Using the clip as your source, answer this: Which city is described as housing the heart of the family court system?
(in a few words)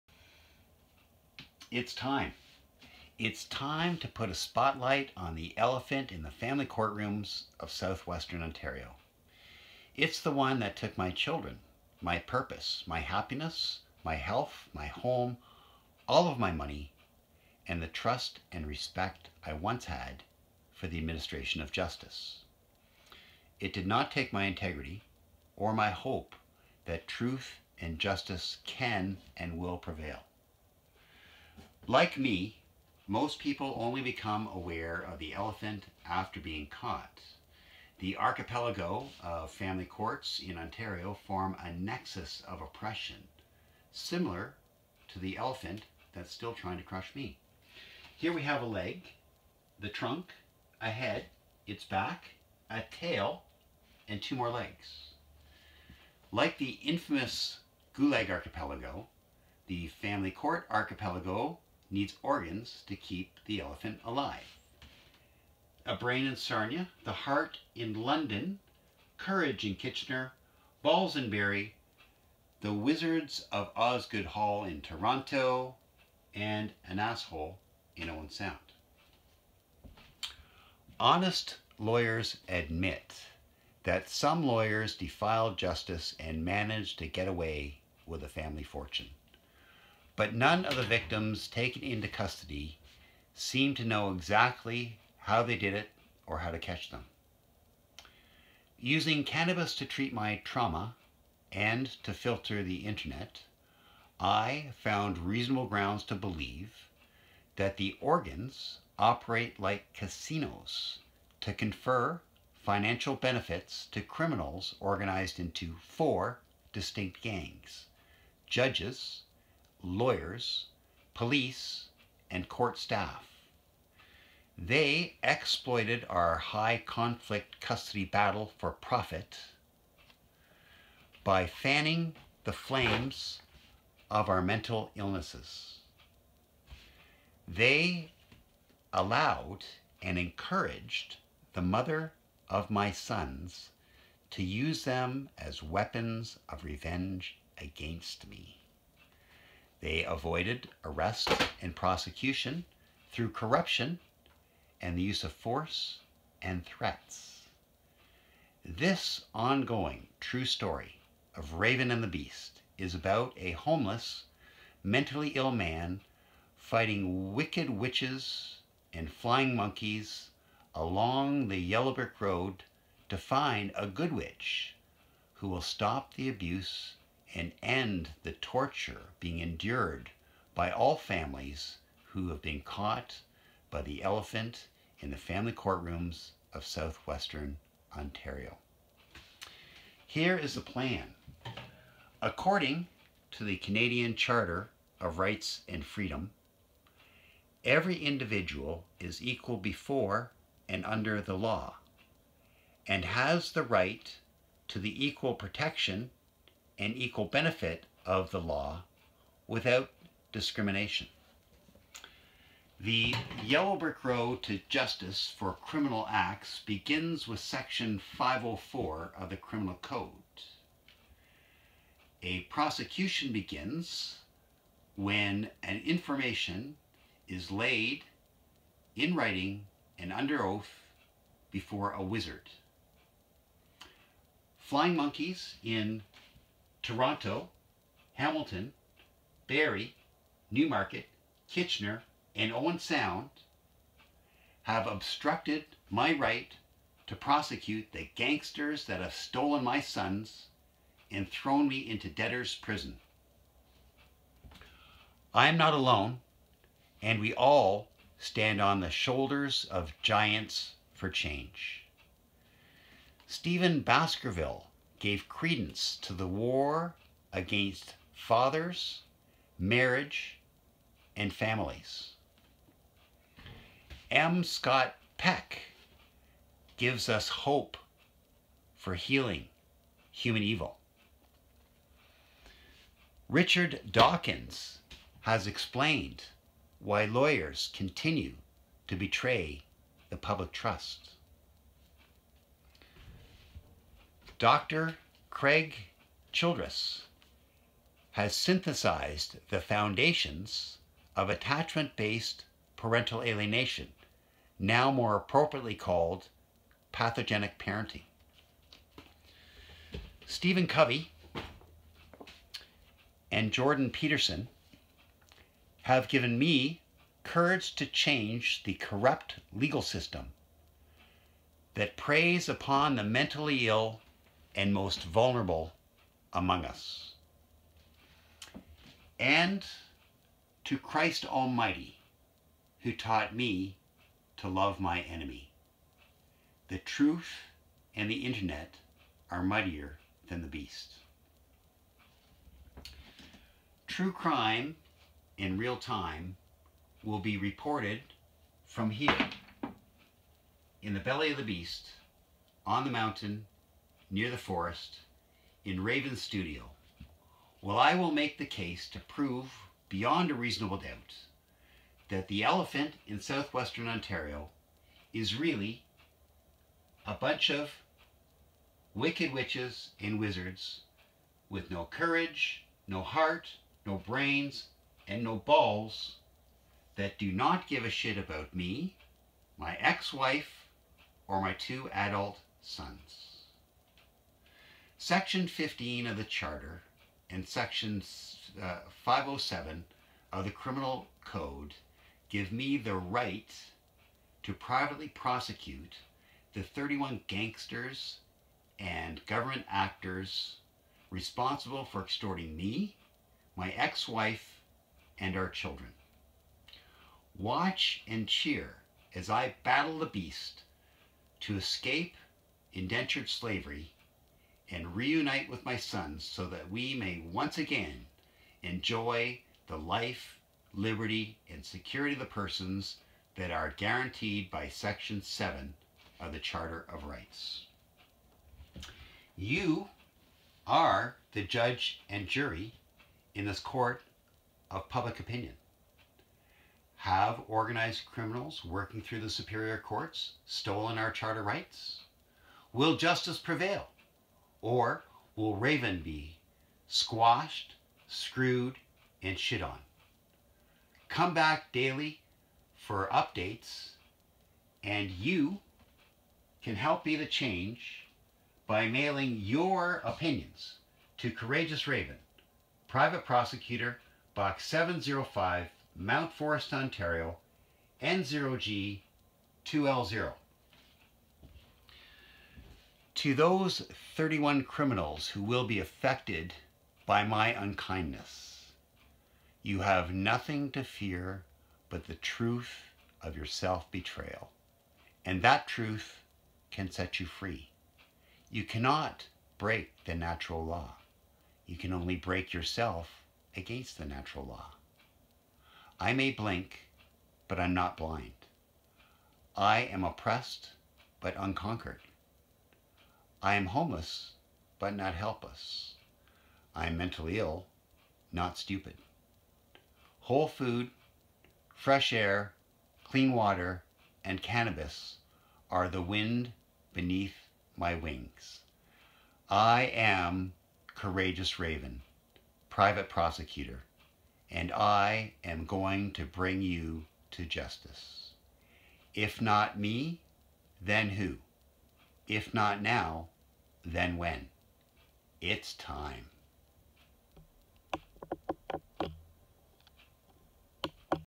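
London.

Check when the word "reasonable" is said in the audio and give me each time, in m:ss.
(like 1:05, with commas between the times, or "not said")
1:45, 6:00.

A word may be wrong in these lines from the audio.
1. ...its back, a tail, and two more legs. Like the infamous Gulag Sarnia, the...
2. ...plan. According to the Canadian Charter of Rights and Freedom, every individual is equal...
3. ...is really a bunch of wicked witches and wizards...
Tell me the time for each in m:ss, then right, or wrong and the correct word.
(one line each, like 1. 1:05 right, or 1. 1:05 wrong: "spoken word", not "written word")
1. 0:51 wrong: "Archipelago", not "Sarnia"
2. 3:10 right
3. 6:05 right.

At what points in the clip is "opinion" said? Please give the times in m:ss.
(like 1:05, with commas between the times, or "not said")
7:15, 7:40.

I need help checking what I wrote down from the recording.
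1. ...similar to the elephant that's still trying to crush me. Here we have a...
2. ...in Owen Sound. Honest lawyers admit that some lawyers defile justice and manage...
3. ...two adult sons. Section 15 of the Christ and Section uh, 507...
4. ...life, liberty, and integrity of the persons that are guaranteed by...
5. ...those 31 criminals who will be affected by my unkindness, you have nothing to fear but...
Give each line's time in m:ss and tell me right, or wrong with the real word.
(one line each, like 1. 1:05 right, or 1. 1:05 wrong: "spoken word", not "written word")
1. 0:43 right
2. 1:17 right
3. 6:21 wrong: "Charter", not "Christ"
4. 6:59 wrong: "security", not "integrity"
5. 7:53 right.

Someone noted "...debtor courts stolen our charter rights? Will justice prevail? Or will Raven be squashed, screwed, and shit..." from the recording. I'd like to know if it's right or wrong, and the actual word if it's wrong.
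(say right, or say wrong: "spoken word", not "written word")
wrong: "superior", not "debtor".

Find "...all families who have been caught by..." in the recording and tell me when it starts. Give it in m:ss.
3:00.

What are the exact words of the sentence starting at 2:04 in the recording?
They exploited our high conflict custody battle for profit by fanning the flames of our mental illnesses.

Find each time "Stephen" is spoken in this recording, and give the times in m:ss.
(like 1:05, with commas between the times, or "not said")
4:23, 5:10.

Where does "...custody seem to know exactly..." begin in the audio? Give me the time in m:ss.
1:32.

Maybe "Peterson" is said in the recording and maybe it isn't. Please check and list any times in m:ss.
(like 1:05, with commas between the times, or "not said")
5:13.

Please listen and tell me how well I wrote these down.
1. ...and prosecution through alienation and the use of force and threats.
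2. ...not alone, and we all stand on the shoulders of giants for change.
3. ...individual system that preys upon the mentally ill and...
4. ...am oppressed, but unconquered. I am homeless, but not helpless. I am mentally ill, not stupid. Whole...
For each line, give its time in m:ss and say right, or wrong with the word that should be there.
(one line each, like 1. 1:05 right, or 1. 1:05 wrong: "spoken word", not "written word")
1. 2:31 wrong: "corruption", not "alienation"
2. 4:15 right
3. 5:19 wrong: "legal", not "individual"
4. 8:19 right.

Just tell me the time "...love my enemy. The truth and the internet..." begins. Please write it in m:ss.
5:34.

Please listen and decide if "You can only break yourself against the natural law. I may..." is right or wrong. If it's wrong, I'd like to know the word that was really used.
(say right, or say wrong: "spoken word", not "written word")
right.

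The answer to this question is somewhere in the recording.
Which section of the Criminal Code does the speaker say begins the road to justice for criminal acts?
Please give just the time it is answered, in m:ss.
3:37.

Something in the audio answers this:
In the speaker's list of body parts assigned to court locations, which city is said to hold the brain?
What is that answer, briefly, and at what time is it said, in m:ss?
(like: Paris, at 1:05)
Sarnia, at 1:05.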